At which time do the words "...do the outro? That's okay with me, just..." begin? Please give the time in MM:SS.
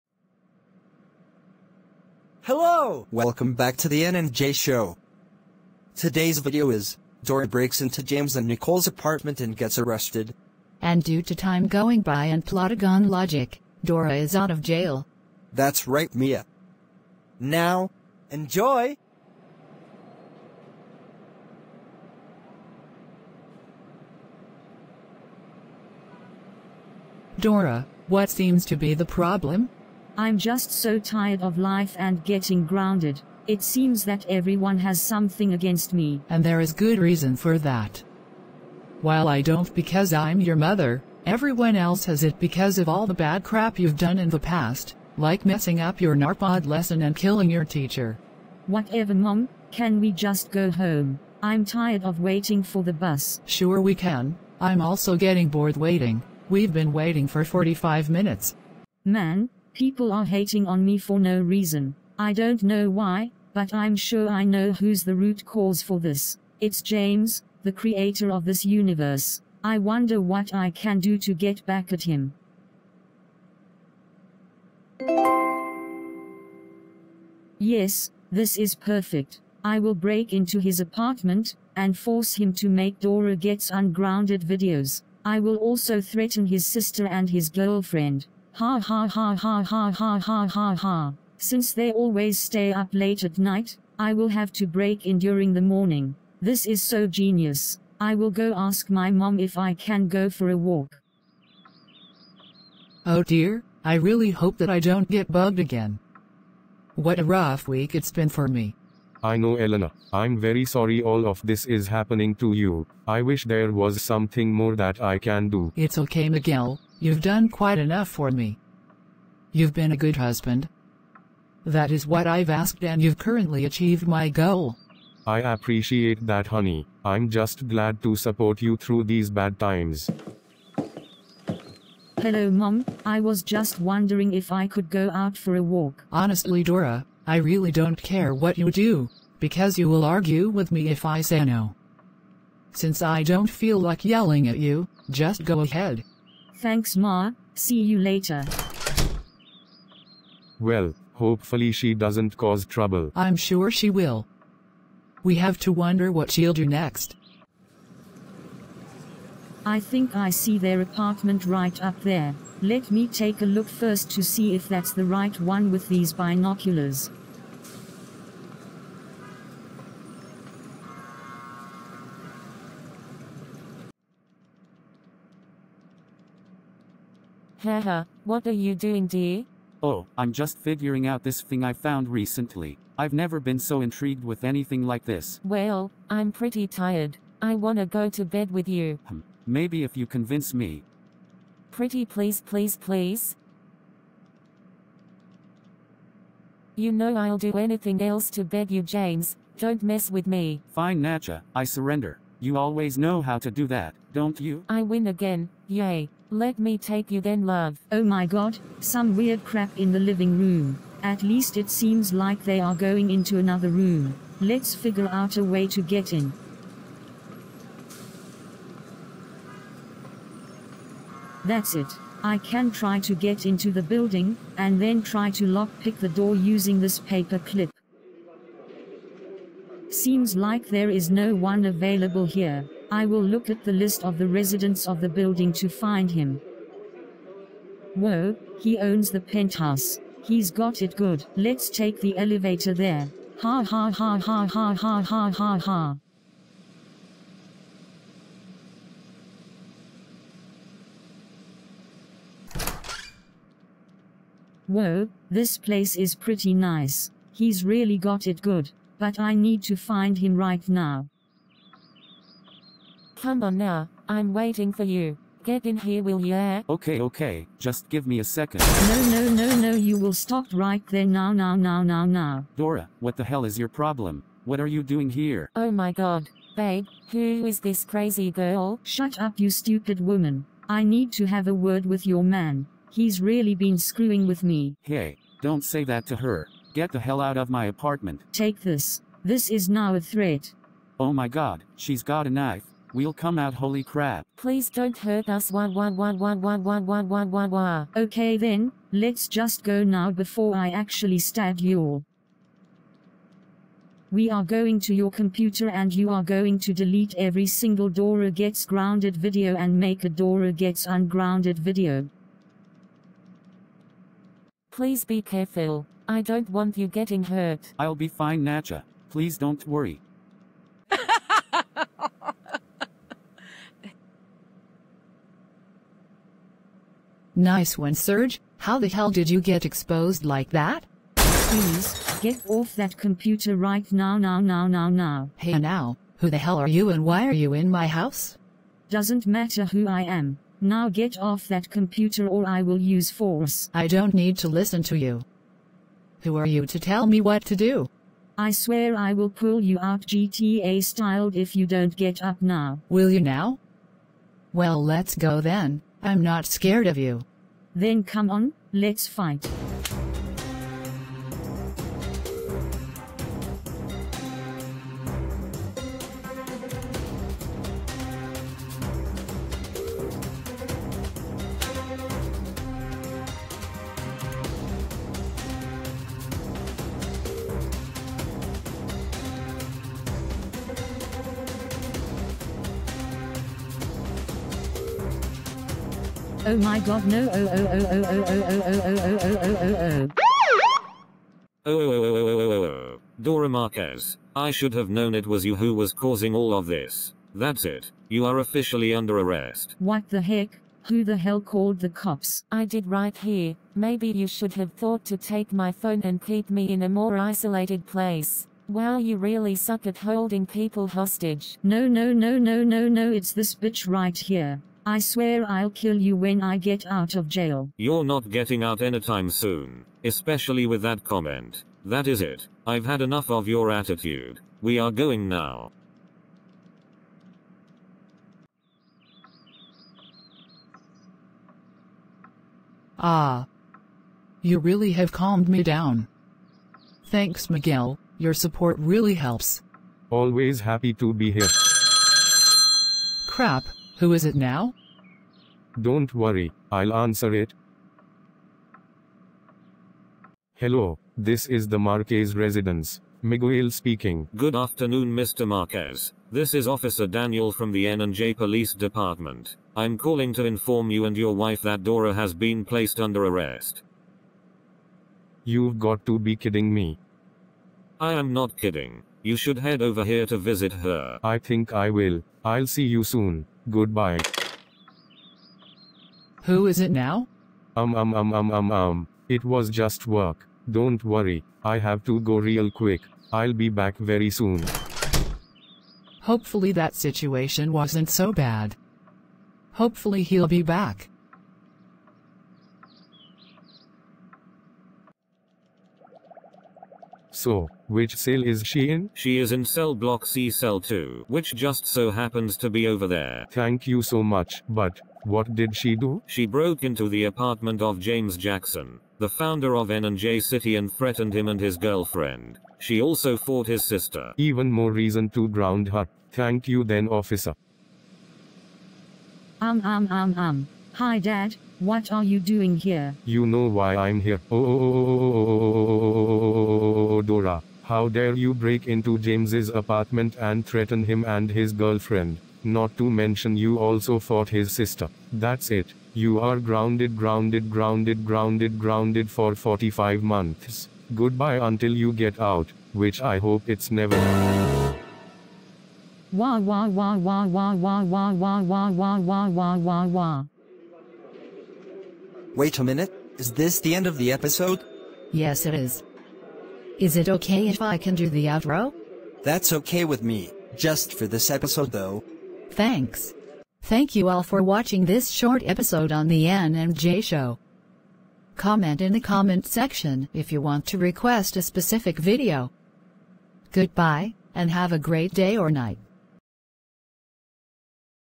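09:18.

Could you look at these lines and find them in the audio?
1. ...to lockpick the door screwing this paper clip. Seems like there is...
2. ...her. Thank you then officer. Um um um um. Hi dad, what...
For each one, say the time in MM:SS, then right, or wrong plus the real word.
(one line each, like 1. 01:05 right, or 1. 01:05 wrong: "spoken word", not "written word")
1. 03:45 wrong: "using", not "screwing"
2. 08:35 right.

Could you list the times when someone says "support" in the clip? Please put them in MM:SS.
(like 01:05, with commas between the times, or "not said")
02:08, 07:18.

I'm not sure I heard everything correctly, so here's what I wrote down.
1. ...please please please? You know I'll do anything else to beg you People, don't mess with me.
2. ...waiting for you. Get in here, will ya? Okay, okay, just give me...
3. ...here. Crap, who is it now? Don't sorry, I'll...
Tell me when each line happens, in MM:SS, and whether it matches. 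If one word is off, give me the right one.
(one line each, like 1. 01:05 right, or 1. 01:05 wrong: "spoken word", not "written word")
1. 03:12 wrong: "James", not "People"
2. 04:24 right
3. 07:21 wrong: "worry", not "sorry".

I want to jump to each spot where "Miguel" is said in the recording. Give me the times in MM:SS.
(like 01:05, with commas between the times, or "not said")
01:56, 07:17, 07:33.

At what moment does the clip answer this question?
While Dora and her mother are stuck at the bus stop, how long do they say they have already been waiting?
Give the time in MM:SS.
00:57.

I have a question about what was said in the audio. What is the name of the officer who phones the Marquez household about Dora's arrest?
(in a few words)
Officer Daniel.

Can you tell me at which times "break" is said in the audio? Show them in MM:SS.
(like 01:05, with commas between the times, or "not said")
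00:07, 01:19, 01:34, 08:48.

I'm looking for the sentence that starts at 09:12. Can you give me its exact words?
Wait a minute, is this the end of the episode?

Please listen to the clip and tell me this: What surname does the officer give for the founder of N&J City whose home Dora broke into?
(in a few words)
Jackson.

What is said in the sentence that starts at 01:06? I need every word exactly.
It's James, the creator of this universe.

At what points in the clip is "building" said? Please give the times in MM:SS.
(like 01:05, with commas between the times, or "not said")
03:43, 03:55.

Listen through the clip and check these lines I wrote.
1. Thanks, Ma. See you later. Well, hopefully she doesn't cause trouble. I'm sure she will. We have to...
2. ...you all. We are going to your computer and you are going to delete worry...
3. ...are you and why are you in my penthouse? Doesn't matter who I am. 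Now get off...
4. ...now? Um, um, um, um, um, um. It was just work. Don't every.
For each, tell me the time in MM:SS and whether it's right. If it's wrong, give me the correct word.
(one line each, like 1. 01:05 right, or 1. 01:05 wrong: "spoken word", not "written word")
1. 02:26 right
2. 05:01 wrong: "every", not "worry"
3. 05:36 wrong: "house", not "penthouse"
4. 07:56 wrong: "worry", not "every".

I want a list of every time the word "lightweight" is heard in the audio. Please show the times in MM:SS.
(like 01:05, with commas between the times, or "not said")
not said.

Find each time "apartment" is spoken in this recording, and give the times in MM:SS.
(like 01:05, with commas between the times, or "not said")
00:08, 01:20, 02:40, 04:47, 08:27, 08:49.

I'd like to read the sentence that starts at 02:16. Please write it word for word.
Honestly Dora, I really don't care what you do, because you will argue with me if I say no.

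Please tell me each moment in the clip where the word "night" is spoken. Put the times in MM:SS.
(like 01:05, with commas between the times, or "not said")
01:33, 09:35.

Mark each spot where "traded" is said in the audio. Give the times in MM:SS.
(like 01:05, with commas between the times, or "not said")
not said.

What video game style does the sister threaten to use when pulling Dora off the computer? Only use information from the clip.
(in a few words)
GTA.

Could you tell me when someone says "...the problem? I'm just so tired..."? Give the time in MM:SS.
00:28.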